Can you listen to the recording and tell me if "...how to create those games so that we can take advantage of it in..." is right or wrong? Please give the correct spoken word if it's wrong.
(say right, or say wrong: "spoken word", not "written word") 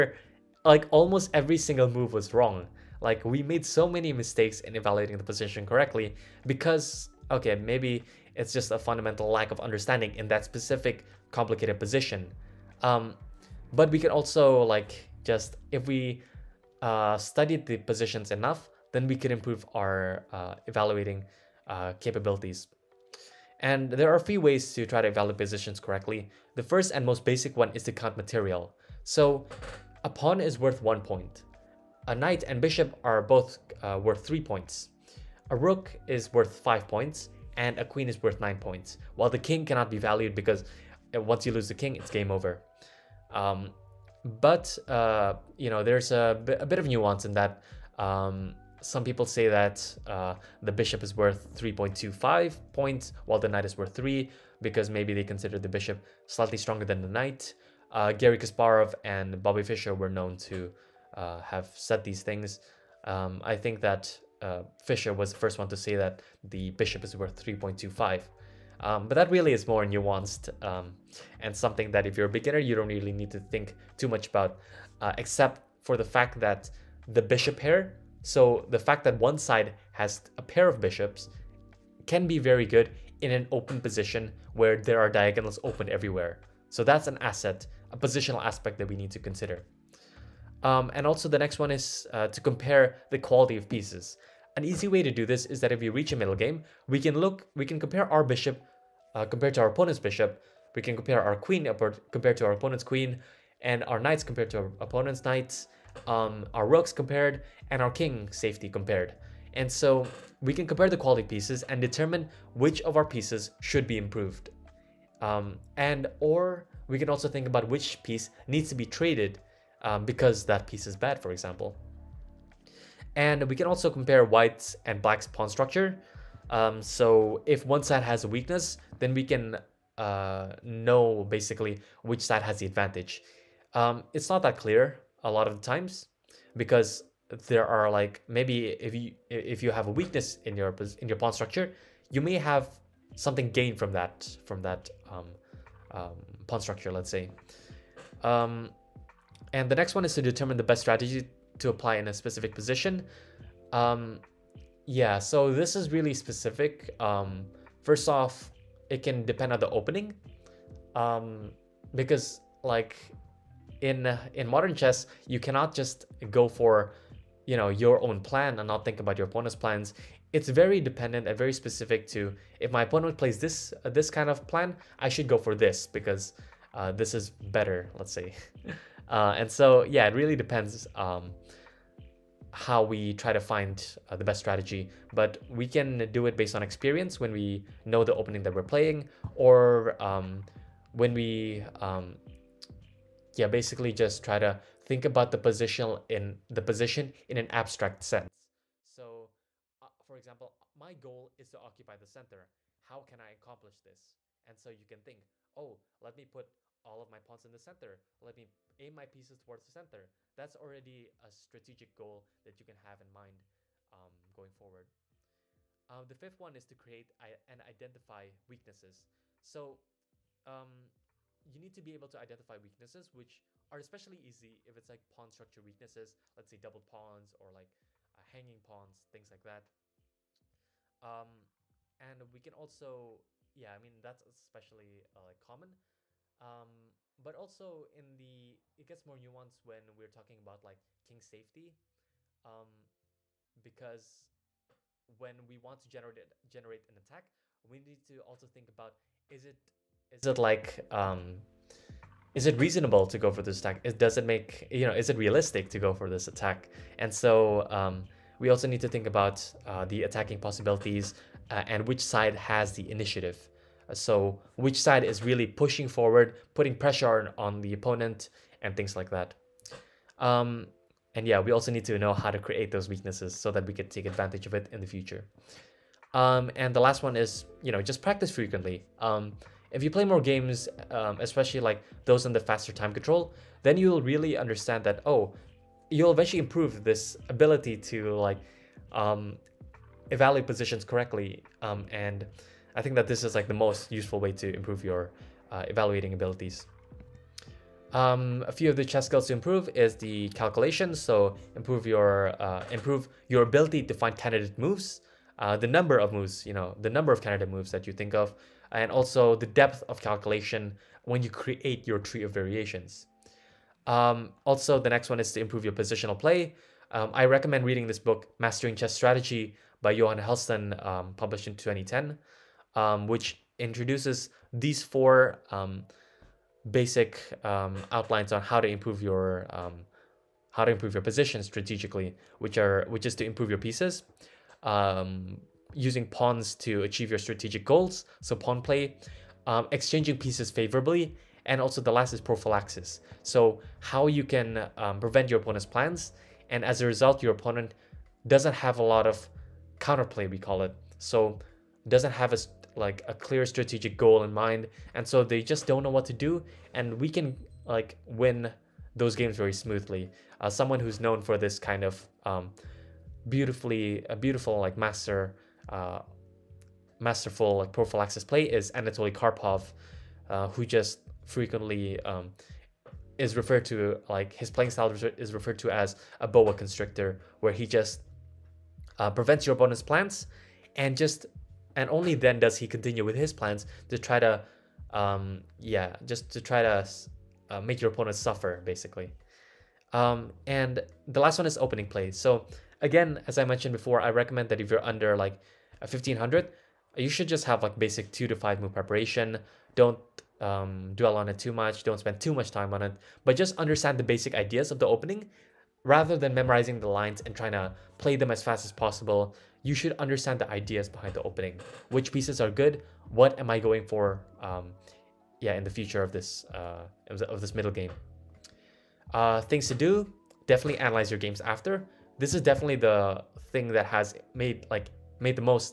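wrong: "weaknesses", not "games".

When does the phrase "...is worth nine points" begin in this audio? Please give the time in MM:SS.
00:38.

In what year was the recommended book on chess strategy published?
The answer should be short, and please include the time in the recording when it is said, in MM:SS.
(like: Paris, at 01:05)
2010, at 05:21.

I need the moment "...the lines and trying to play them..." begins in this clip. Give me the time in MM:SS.
06:46.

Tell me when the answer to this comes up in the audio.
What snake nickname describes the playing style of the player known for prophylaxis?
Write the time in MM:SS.
06:16.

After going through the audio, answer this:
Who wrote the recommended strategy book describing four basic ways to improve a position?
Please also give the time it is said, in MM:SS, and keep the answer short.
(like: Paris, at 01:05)
Johan Hellsten, at 05:19.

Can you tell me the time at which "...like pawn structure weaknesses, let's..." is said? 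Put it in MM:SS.
03:44.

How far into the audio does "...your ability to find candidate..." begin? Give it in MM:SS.
05:03.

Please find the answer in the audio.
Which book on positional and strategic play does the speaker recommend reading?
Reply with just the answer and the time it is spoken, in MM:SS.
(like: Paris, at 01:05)
Mastering Chess Strategy, at 05:18.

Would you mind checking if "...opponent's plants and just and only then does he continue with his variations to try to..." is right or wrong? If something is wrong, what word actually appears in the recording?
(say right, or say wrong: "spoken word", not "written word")
wrong: "plans", not "variations".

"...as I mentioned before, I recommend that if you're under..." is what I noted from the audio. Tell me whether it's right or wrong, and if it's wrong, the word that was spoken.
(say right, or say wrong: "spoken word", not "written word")
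right.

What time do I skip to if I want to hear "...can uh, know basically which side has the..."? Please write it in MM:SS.
02:09.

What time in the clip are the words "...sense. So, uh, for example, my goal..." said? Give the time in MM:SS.
03:18.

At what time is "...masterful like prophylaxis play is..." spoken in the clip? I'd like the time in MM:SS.
06:07.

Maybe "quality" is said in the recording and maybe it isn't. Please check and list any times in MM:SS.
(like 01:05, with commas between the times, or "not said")
01:33, 01:50.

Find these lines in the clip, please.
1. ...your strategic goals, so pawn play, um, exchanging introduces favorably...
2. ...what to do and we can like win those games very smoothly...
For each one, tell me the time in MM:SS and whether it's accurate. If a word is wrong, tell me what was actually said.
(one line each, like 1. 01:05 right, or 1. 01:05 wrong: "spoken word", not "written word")
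1. 05:37 wrong: "pieces", not "introduces"
2. 05:55 right.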